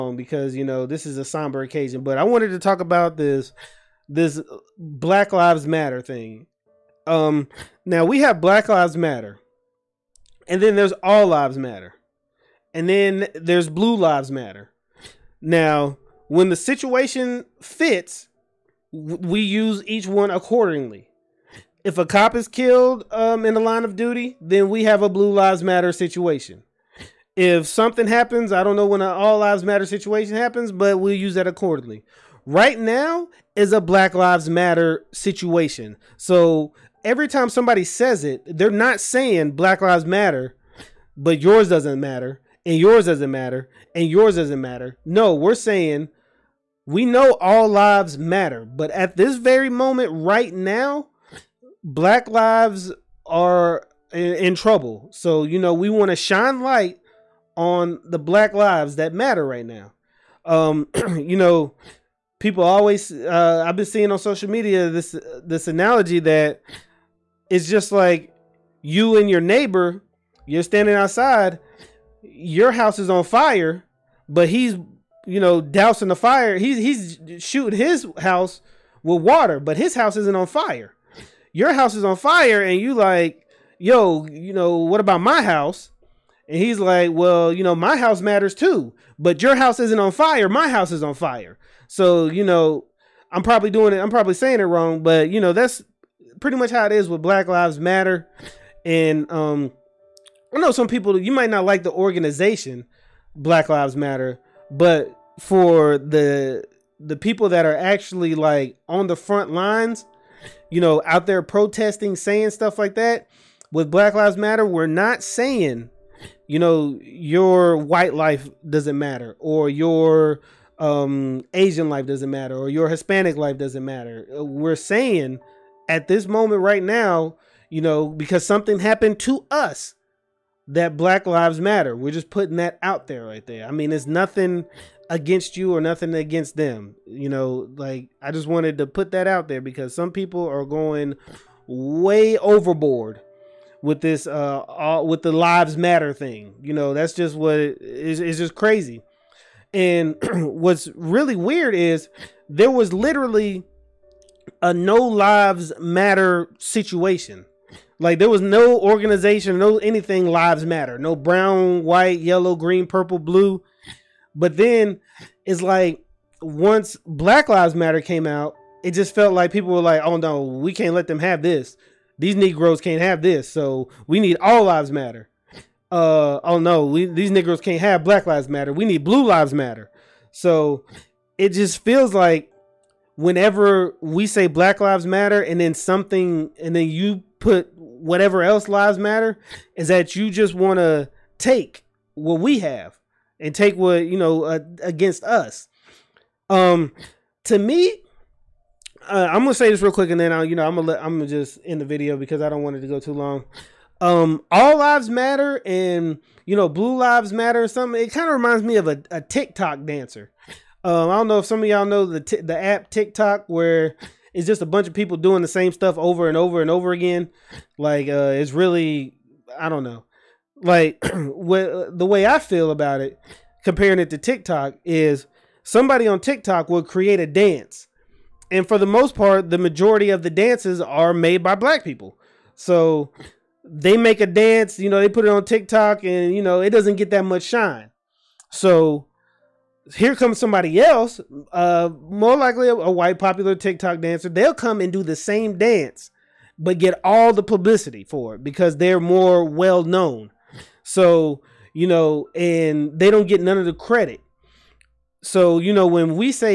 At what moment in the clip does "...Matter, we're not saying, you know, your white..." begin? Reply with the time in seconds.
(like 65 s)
114 s.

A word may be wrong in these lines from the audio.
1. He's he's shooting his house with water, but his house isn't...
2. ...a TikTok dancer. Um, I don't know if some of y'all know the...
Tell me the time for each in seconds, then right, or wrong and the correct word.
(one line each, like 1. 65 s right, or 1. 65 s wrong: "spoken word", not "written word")
1. 76 s right
2. 209 s right.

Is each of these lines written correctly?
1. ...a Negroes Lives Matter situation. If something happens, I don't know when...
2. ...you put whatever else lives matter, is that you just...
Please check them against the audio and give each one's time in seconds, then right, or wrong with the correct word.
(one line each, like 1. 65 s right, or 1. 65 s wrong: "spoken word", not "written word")
1. 25 s wrong: "Blue", not "Negroes"
2. 186 s right.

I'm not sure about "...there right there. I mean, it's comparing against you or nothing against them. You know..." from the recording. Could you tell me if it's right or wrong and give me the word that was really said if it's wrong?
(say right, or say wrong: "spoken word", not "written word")
wrong: "nothing", not "comparing".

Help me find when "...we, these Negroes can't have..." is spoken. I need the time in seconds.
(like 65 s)
176 s.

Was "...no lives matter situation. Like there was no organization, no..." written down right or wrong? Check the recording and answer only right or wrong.
right.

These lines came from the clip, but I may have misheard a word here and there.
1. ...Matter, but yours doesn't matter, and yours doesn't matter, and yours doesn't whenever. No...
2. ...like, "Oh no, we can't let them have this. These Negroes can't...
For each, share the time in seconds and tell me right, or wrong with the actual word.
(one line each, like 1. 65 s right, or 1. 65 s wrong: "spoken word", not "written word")
1. 40 s wrong: "matter", not "whenever"
2. 169 s right.